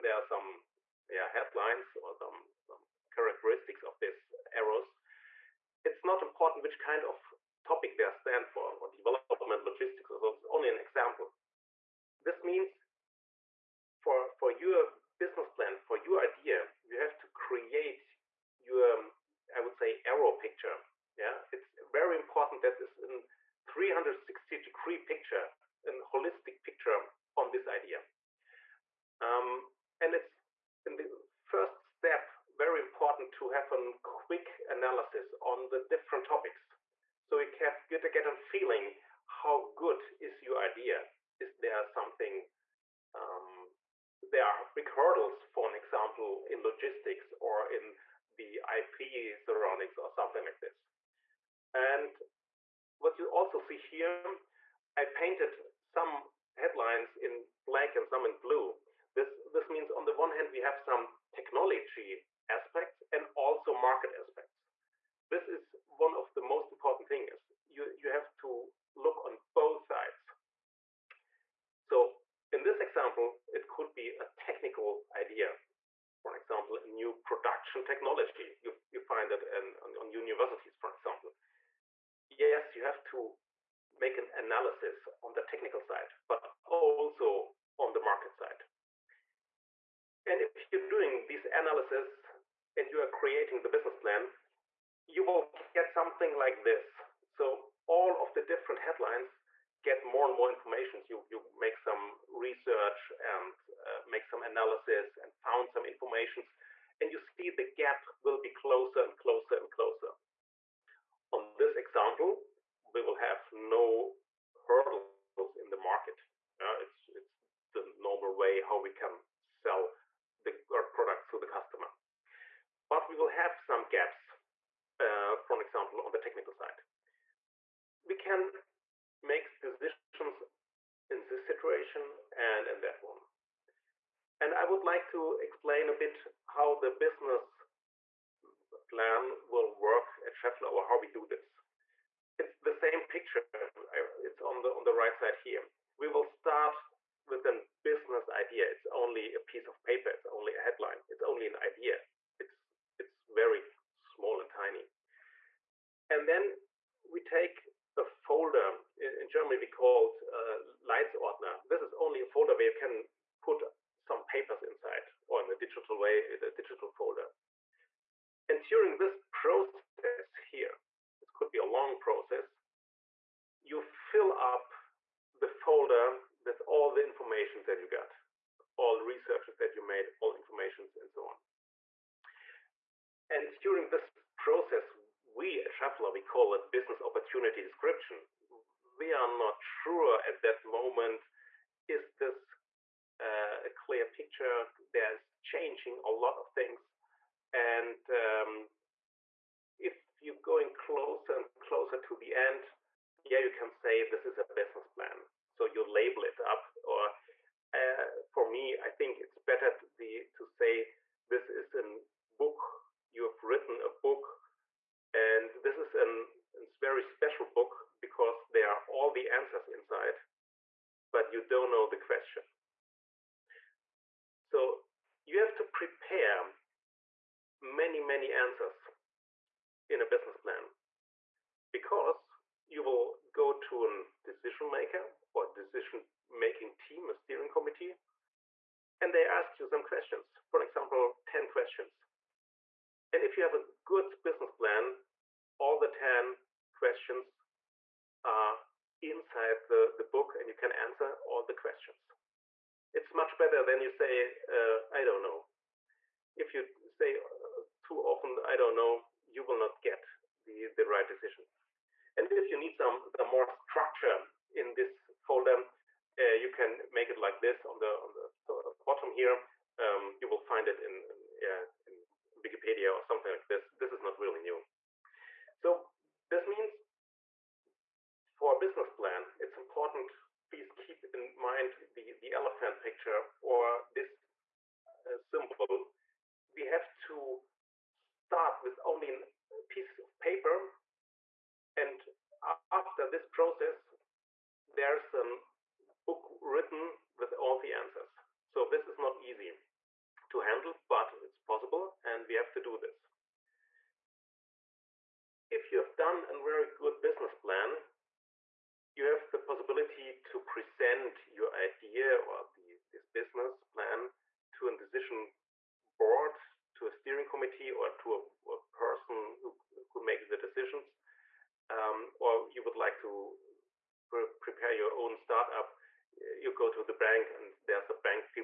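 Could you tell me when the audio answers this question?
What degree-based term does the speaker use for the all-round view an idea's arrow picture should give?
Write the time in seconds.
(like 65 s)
23 s.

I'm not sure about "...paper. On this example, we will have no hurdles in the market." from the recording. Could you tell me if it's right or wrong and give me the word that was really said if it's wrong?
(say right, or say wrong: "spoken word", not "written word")
wrong: "closer", not "paper".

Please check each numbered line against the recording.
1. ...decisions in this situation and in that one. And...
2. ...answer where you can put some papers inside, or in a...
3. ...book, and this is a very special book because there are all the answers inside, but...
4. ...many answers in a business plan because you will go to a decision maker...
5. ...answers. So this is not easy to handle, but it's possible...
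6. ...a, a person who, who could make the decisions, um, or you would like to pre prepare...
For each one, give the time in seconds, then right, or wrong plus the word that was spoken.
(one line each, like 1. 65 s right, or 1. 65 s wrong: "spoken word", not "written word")
1. 129 s right
2. 162 s wrong: "folder", not "answer"
3. 213 s right
4. 227 s right
5. 297 s right
6. 318 s right.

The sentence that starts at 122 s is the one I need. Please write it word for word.
But we will have some gaps, uh, for example, on the technical side.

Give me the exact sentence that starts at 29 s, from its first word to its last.
Um, and it's in the first step very important to have a quick analysis on the different topics.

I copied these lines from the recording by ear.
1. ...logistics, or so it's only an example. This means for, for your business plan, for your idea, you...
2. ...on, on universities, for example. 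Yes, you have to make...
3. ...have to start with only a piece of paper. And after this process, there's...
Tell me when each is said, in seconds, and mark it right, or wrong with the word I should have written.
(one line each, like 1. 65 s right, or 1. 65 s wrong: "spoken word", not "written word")
1. 9 s right
2. 79 s right
3. 286 s right.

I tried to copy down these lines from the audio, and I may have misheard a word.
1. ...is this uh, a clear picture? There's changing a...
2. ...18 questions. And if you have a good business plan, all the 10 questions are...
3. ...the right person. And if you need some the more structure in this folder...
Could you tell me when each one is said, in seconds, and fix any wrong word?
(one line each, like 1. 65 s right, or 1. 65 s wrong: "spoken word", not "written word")
1. 191 s right
2. 241 s wrong: "10", not "18"
3. 260 s wrong: "decision", not "person".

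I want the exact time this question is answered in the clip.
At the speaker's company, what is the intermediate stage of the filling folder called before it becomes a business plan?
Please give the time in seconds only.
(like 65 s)
186 s.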